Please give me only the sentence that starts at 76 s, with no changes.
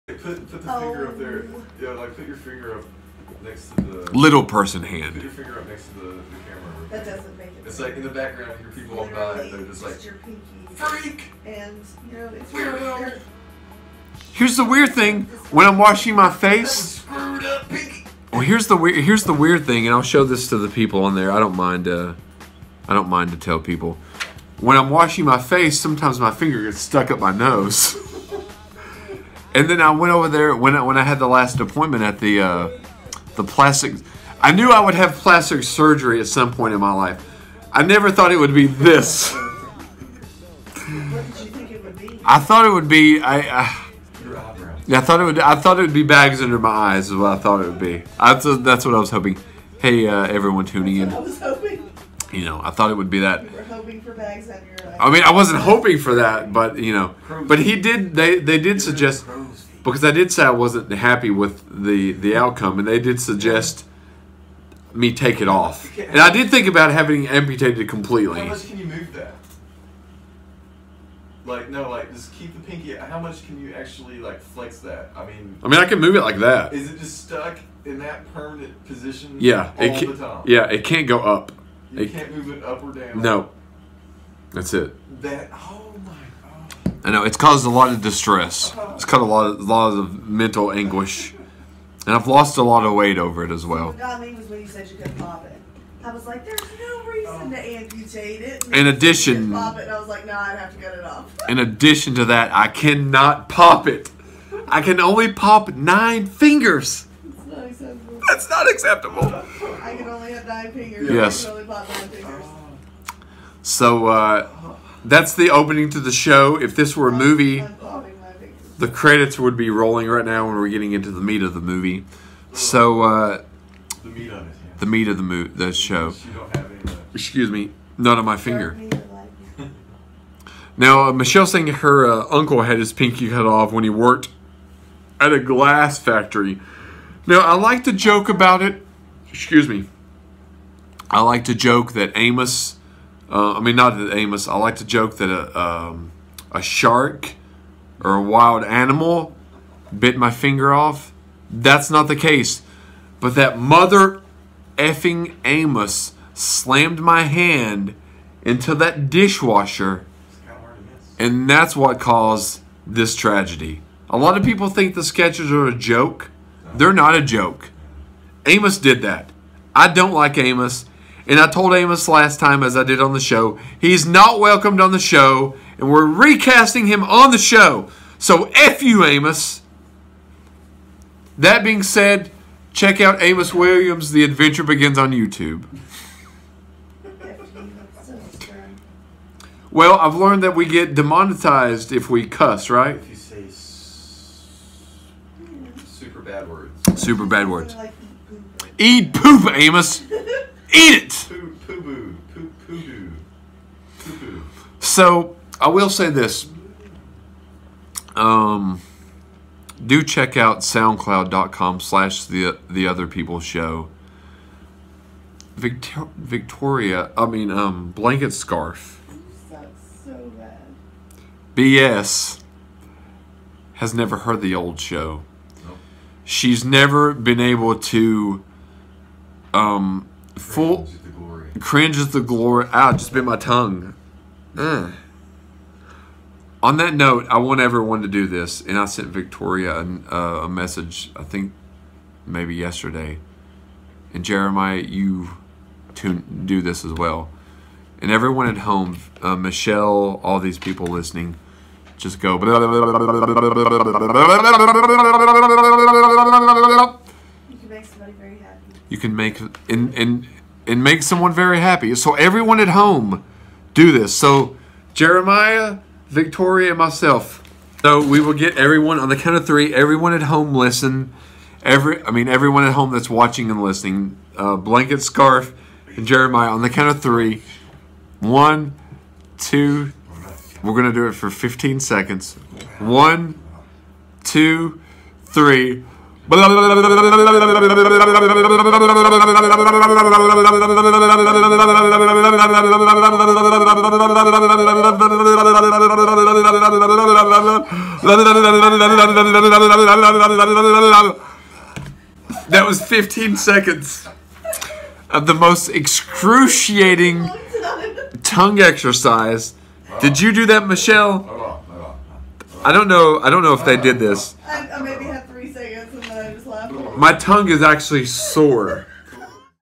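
Is it just stuck in that permanent position?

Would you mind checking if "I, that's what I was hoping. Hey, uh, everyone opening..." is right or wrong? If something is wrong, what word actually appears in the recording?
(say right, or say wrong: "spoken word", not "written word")
wrong: "tuning", not "opening".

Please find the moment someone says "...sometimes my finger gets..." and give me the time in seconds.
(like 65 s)
25 s.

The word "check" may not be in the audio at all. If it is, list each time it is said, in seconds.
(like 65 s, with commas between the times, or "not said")
182 s, 210 s.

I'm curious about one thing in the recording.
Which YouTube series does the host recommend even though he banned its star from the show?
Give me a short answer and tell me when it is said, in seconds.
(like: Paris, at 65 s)
Amos Williams, The Adventure Begins, at 183 s.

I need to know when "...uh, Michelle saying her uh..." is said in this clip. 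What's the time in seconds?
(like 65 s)
131 s.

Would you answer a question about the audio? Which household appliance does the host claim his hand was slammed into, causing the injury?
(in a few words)
Dishwasher.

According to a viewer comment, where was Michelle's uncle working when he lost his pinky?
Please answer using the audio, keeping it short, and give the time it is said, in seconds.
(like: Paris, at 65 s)
Glass factory, at 135 s.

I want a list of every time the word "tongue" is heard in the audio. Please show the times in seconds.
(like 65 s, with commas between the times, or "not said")
233 s, 308 s, 317 s.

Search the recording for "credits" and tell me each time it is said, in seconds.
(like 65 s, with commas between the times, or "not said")
118 s.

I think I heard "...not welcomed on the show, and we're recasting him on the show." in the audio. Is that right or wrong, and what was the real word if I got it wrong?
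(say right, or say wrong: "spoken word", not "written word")
right.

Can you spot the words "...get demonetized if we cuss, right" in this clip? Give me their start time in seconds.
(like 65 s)
190 s.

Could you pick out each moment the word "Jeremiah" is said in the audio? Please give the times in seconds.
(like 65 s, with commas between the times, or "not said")
244 s, 264 s, 276 s.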